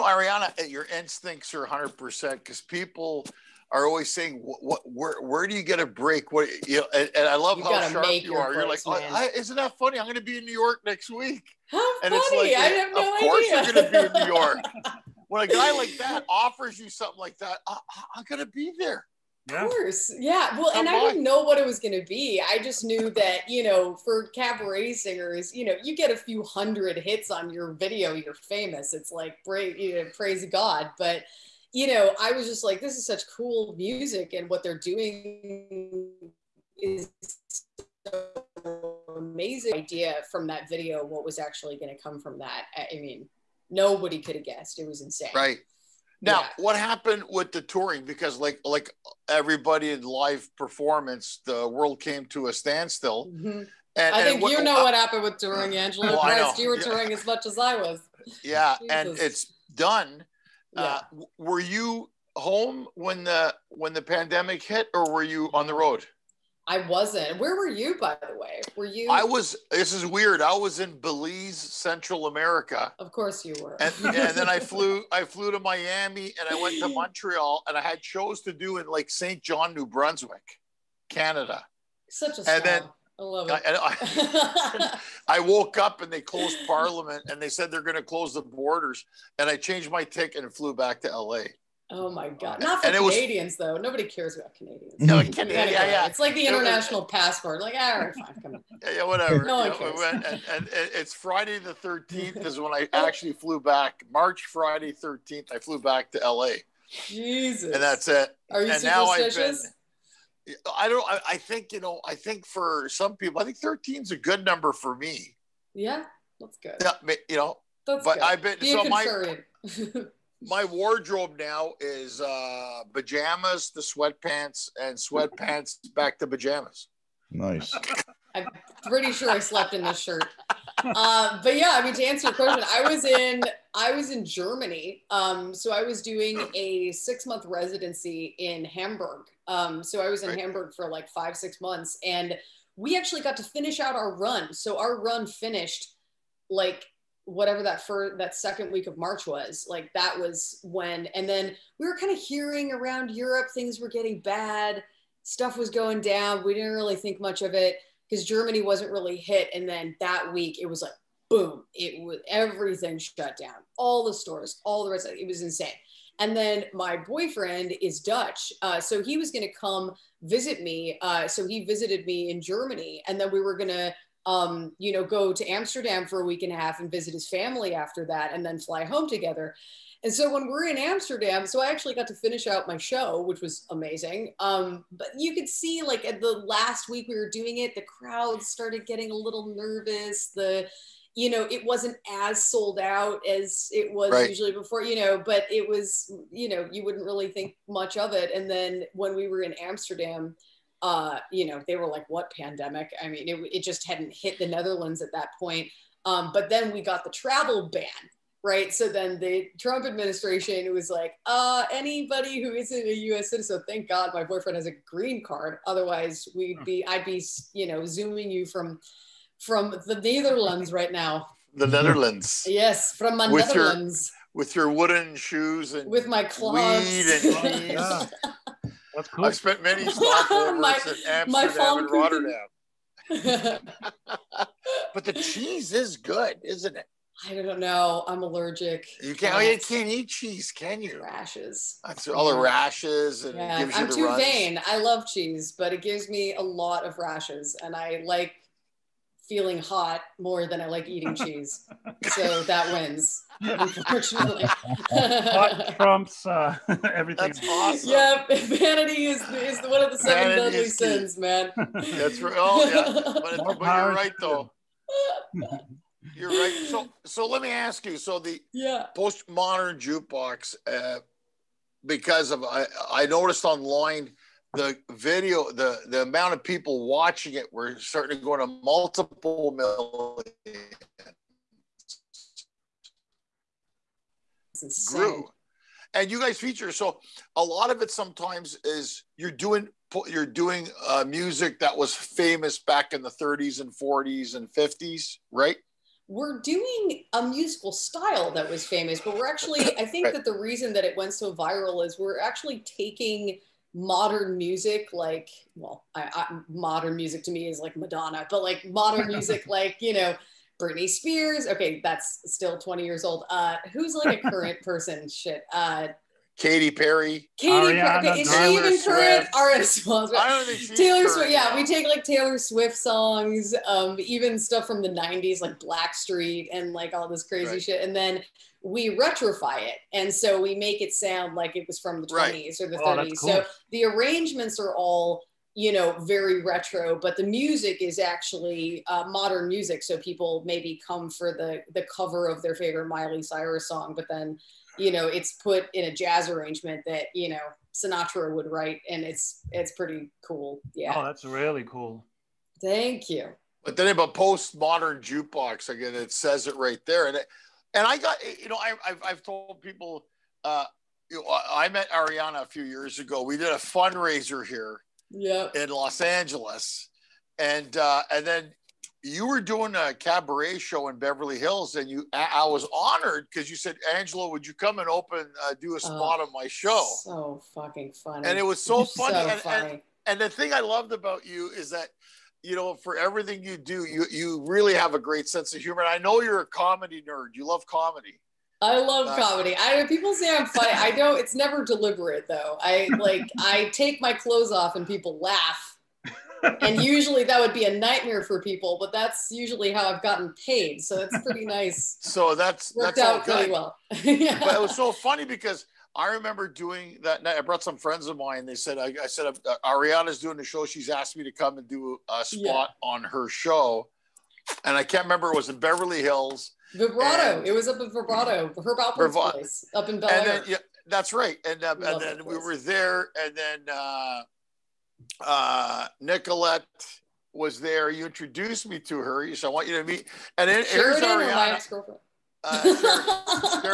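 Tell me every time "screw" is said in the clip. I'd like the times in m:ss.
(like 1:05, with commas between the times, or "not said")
not said.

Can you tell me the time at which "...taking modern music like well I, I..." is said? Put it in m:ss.
5:02.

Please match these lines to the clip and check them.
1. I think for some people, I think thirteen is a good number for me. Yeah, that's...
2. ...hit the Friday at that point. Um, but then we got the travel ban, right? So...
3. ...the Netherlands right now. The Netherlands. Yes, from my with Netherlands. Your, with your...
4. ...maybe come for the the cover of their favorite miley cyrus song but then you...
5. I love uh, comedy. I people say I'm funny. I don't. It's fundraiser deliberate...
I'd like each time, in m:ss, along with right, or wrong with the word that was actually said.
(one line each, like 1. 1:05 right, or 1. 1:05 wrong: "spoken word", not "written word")
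1. 1:52 right
2. 3:24 wrong: "Netherlands", not "Friday"
3. 3:39 right
4. 5:40 right
5. 6:28 wrong: "never", not "fundraiser".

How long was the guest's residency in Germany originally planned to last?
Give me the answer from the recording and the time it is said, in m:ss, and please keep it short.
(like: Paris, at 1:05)
six months, at 2:16.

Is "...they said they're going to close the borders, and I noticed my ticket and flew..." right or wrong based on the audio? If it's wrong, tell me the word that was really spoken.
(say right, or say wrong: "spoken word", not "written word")
wrong: "changed", not "noticed".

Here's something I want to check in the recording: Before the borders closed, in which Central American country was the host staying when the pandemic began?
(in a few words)
Belize.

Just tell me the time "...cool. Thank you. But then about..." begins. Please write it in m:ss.
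5:51.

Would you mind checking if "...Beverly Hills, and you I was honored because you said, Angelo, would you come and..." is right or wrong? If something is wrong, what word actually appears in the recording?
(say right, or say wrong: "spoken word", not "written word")
right.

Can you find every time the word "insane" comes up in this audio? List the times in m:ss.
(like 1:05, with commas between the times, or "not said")
0:45, 2:45.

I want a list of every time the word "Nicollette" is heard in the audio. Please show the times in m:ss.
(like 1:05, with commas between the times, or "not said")
7:06.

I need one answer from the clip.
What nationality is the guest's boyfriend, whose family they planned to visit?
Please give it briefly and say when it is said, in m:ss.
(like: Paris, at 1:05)
Dutch, at 2:47.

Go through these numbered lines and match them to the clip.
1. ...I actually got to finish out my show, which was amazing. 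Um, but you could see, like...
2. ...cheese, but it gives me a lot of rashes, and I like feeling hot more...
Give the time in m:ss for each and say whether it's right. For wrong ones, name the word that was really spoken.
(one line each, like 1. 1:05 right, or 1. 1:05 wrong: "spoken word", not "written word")
1. 3:01 right
2. 4:05 right.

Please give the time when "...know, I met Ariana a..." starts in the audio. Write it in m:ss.
6:01.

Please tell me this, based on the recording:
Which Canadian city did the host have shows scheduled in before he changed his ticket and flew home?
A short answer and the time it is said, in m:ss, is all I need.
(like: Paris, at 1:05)
Saint John, New Brunswick, at 1:19.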